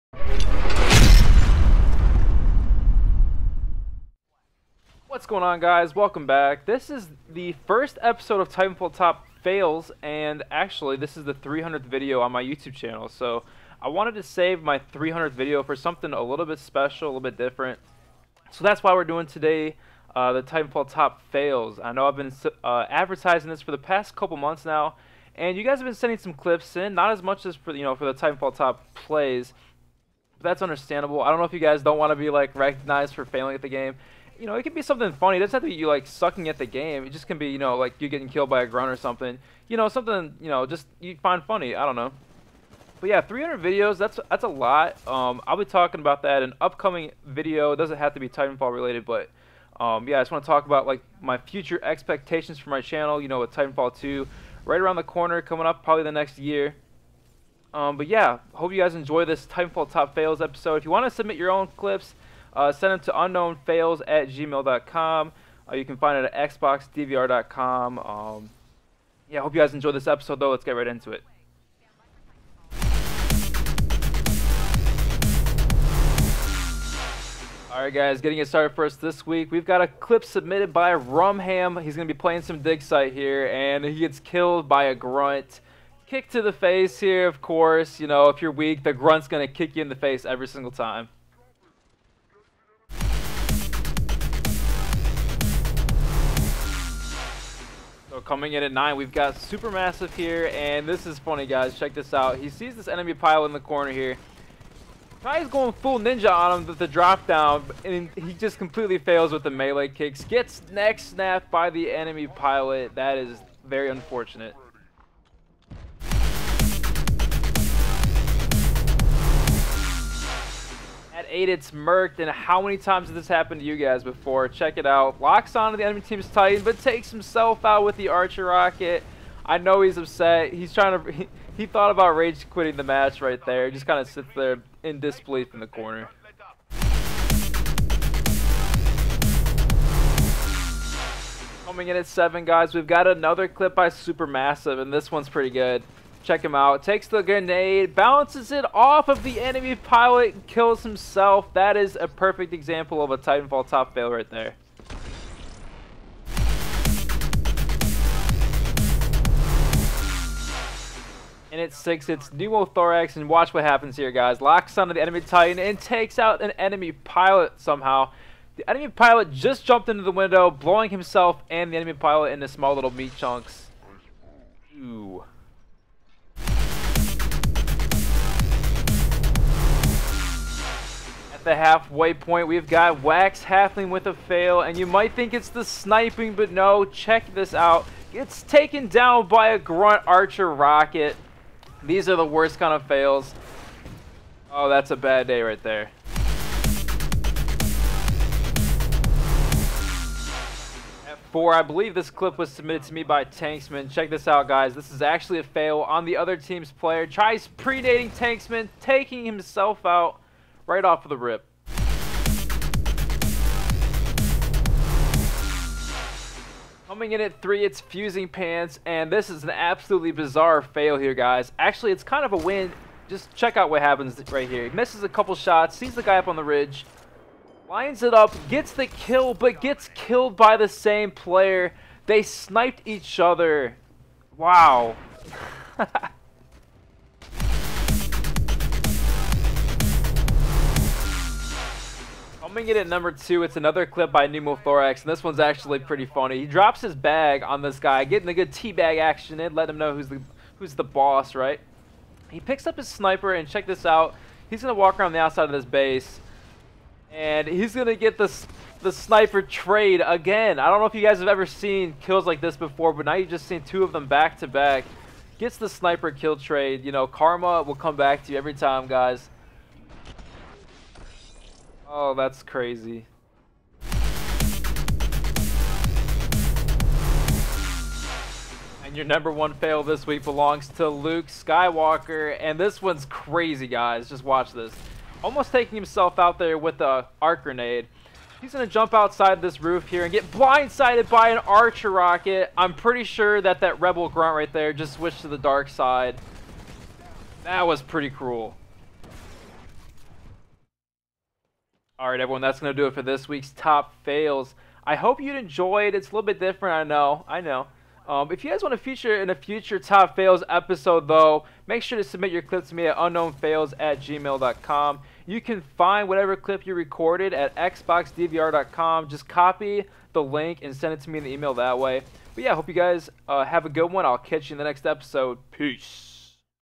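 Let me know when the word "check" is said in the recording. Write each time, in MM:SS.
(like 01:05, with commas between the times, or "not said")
01:41, 02:04, 02:26, 03:06, 03:23, 03:43, 04:13.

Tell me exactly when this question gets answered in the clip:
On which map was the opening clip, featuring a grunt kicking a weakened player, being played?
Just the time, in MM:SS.
01:22.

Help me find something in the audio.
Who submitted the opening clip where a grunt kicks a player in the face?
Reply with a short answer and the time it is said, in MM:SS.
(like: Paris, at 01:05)
Rumham, at 01:20.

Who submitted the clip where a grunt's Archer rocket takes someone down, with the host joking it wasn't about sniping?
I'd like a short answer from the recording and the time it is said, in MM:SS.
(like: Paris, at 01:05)
Wax Halfling, at 03:03.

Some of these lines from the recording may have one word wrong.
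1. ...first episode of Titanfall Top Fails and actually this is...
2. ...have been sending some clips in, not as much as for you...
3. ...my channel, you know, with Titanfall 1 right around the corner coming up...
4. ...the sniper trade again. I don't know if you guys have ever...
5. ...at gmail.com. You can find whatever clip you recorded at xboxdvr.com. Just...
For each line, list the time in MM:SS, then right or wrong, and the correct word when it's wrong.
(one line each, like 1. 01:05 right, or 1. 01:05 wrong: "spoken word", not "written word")
1. 00:07 right
2. 00:25 right
3. 00:52 wrong: "2", not "1"
4. 04:18 right
5. 05:13 right.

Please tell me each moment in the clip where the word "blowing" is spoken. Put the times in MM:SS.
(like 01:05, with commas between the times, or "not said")
02:50.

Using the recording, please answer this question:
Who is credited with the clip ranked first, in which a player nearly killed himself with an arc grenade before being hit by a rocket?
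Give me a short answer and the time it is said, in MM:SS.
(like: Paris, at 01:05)
Luke Skywalker, at 04:40.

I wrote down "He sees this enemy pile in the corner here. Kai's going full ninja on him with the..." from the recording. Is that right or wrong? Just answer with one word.
right.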